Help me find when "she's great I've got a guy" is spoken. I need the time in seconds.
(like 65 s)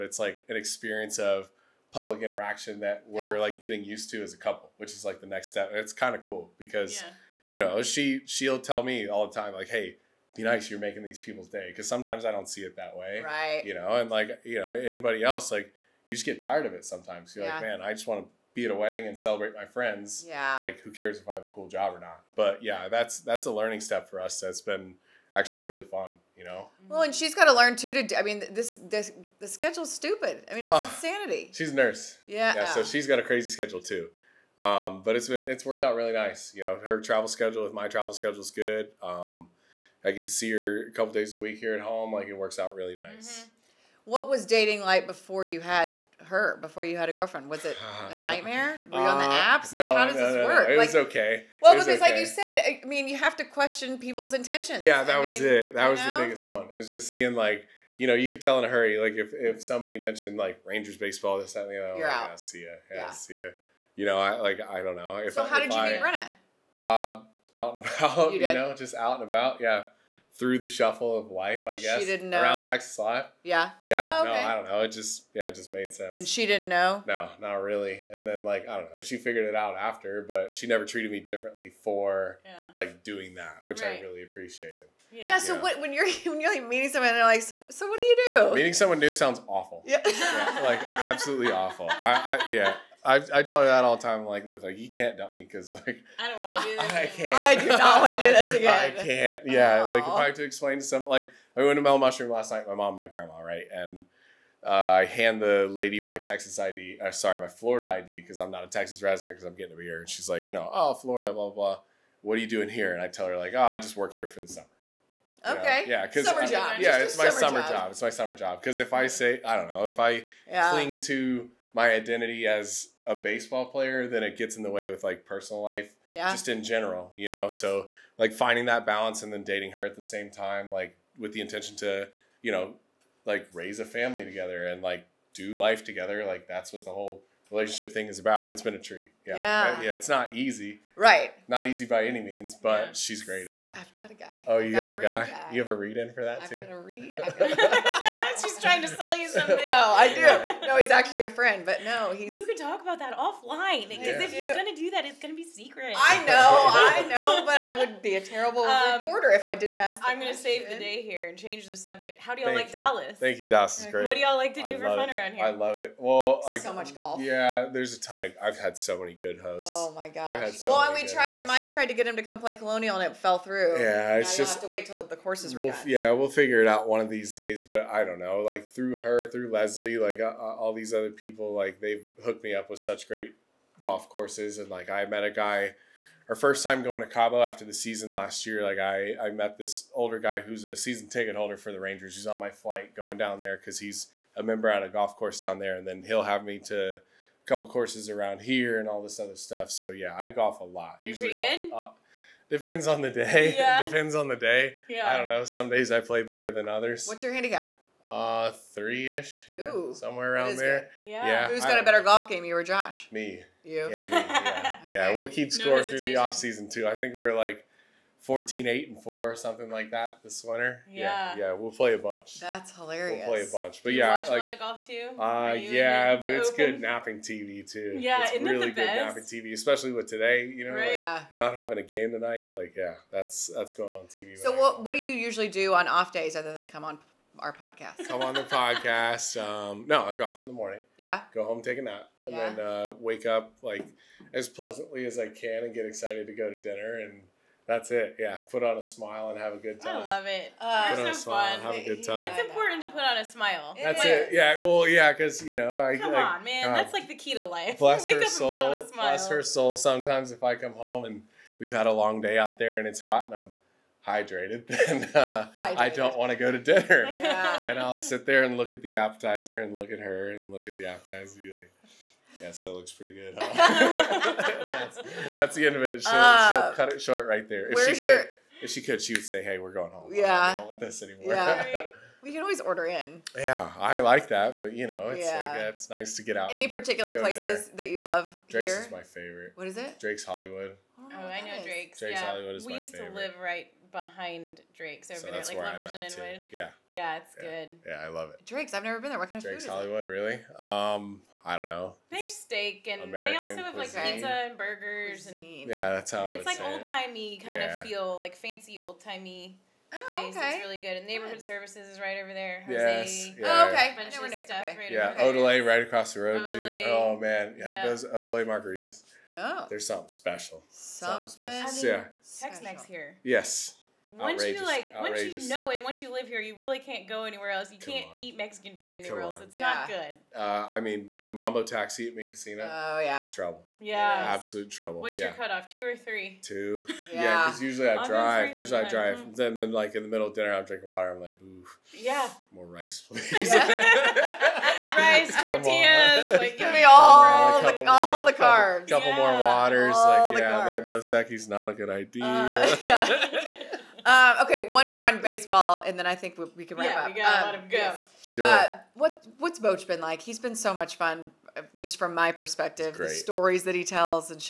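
142 s.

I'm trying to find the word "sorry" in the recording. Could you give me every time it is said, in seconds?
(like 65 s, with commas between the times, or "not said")
107 s.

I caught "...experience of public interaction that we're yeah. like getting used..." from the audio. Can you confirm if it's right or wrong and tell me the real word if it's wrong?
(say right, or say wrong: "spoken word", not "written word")
right.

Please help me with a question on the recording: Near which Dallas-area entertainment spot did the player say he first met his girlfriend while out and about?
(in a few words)
Texas Live.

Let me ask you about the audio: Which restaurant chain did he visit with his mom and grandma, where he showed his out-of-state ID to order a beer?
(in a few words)
Mellow Mushroom.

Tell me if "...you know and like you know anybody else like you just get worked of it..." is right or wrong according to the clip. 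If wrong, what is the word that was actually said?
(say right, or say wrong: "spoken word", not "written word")
wrong: "tired", not "worked".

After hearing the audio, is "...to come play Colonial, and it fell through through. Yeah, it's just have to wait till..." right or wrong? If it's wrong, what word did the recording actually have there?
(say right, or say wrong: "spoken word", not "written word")
right.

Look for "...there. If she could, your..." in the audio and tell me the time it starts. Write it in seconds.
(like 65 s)
277 s.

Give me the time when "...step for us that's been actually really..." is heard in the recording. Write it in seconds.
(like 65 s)
23 s.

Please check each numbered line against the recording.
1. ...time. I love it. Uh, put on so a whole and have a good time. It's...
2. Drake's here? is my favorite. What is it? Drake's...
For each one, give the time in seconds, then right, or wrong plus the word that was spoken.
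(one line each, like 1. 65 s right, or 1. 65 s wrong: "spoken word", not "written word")
1. 249 s wrong: "smile", not "whole"
2. 288 s right.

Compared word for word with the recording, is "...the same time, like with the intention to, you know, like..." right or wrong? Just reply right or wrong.
right.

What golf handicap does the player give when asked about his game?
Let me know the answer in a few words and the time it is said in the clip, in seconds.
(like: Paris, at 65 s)
3, at 208 s.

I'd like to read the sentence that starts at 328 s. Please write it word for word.
eat mexican food anywhere else it's yeah.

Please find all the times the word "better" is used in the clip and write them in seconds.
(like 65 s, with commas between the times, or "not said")
206 s, 211 s.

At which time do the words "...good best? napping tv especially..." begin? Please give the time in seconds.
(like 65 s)
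228 s.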